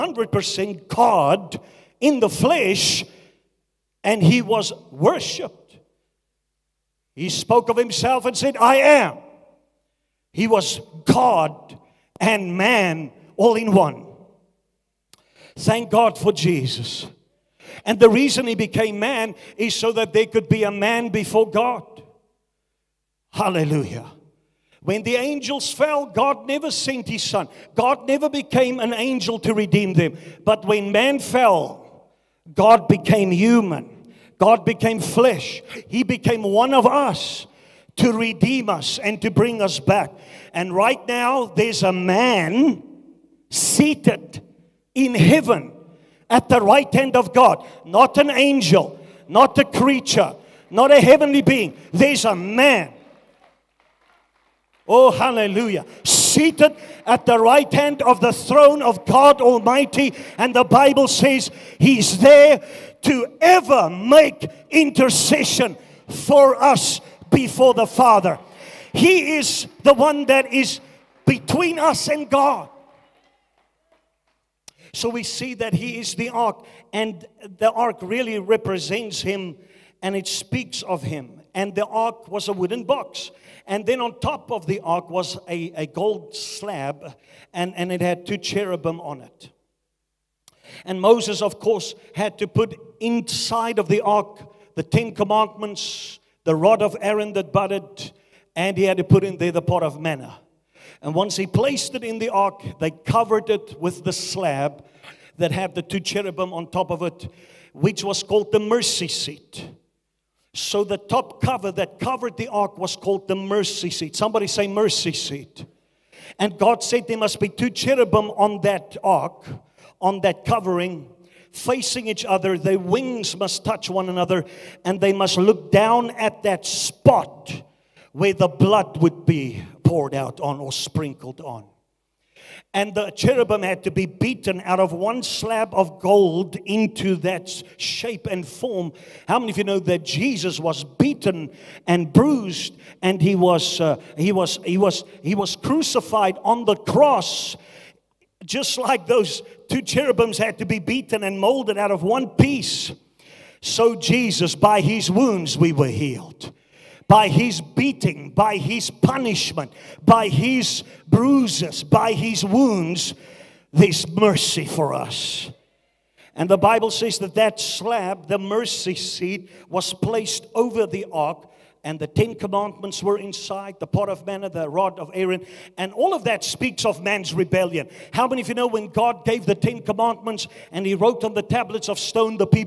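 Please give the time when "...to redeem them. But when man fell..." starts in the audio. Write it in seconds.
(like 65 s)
29 s.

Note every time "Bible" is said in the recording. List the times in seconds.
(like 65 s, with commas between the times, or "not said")
60 s, 166 s.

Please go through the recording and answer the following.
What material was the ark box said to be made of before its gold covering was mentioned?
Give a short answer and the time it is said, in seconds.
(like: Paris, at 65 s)
wooden, at 82 s.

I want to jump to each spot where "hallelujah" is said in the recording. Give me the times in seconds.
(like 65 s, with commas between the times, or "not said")
23 s, 55 s.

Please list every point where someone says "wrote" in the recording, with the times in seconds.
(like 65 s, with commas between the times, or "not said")
180 s.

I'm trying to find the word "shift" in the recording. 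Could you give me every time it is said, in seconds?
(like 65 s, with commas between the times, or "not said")
not said.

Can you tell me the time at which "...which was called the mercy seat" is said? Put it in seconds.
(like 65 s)
107 s.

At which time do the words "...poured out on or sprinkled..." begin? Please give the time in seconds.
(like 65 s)
129 s.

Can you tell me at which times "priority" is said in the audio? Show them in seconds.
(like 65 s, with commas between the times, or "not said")
not said.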